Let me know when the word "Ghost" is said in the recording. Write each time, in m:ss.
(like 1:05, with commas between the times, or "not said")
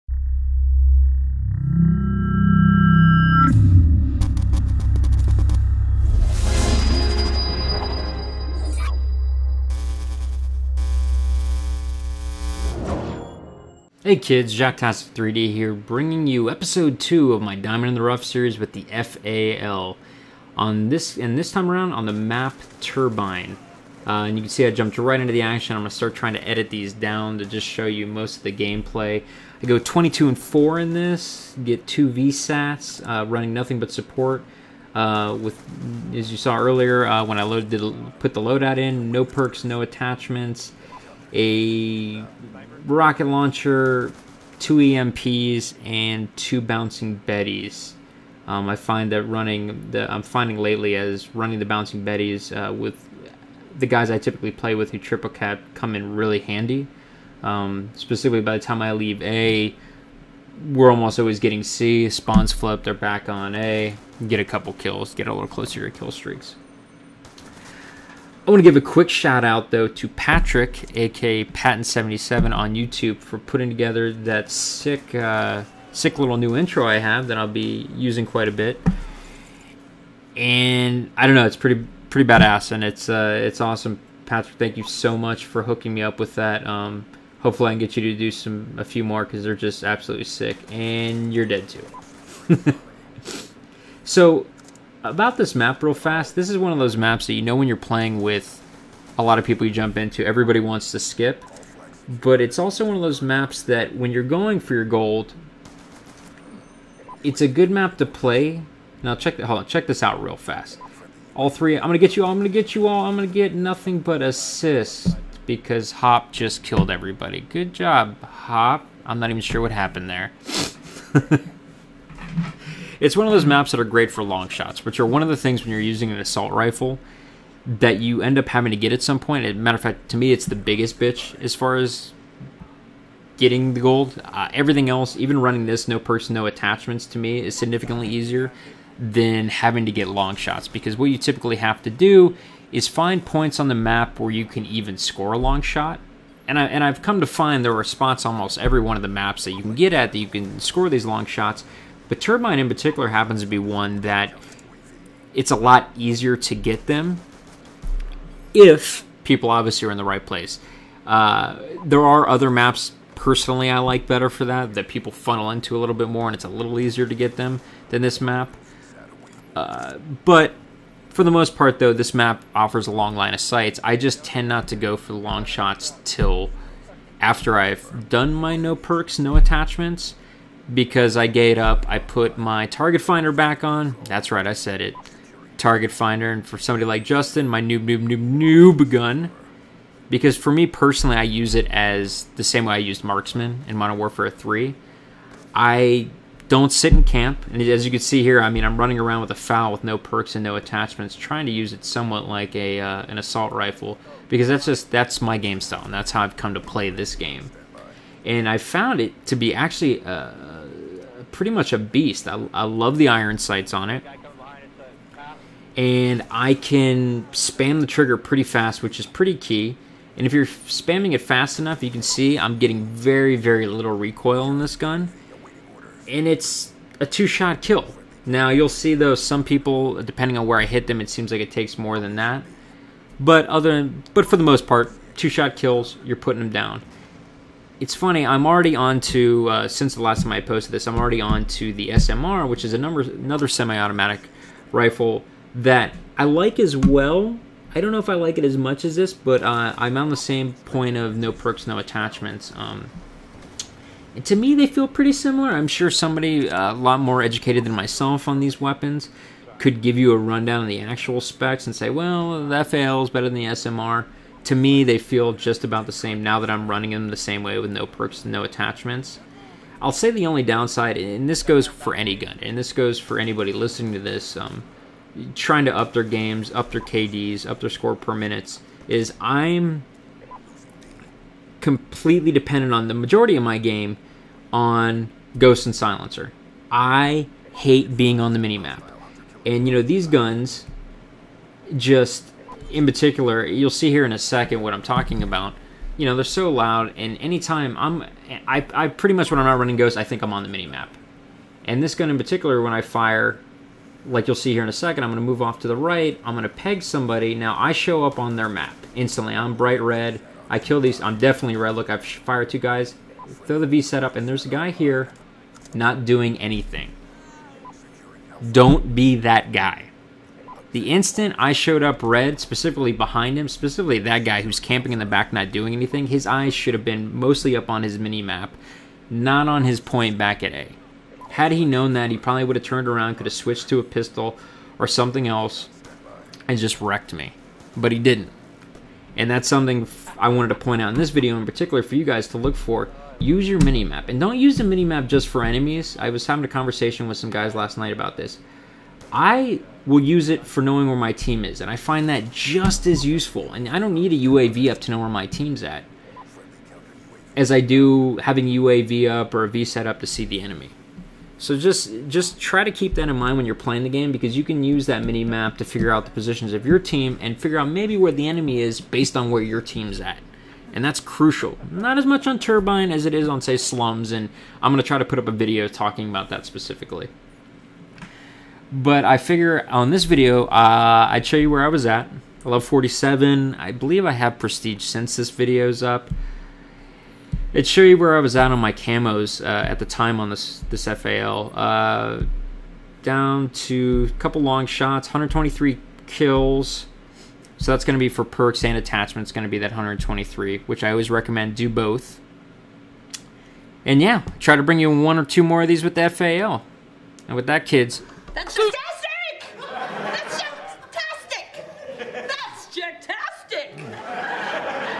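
4:45, 4:59.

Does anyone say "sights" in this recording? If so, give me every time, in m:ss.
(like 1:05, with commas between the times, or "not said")
2:53, 3:33.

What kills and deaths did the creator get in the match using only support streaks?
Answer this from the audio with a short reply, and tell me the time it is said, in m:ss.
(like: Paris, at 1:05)
22 and 4, at 0:29.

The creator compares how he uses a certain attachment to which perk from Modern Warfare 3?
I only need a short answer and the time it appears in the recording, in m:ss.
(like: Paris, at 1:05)
Marksman, at 3:13.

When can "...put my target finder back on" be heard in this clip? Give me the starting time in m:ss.
3:01.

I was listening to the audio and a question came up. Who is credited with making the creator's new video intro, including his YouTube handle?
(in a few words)
Patan77.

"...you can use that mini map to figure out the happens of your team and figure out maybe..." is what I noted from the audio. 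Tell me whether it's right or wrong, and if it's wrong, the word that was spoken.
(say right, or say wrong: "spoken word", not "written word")
wrong: "positions", not "happens".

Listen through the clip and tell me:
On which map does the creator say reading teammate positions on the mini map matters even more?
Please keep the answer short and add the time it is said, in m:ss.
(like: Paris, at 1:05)
Slums, at 6:13.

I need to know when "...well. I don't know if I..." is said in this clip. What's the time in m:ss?
4:06.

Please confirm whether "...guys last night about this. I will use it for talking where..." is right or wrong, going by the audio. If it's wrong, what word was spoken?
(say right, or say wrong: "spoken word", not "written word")
wrong: "knowing", not "talking".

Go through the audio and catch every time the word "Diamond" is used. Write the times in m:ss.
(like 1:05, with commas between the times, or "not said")
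0:17.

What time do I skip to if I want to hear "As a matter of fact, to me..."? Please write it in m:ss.
2:09.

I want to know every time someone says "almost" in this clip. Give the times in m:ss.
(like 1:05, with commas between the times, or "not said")
1:00, 2:28.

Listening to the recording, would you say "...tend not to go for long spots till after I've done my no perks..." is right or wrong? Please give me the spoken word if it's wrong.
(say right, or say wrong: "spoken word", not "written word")
wrong: "shots", not "spots".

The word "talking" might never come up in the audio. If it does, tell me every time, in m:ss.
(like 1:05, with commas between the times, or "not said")
4:54, 6:15.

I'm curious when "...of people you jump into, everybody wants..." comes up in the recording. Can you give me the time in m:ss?
1:39.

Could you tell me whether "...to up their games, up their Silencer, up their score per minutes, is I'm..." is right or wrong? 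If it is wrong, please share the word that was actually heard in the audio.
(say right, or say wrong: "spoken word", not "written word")
wrong: "KDs", not "Silencer".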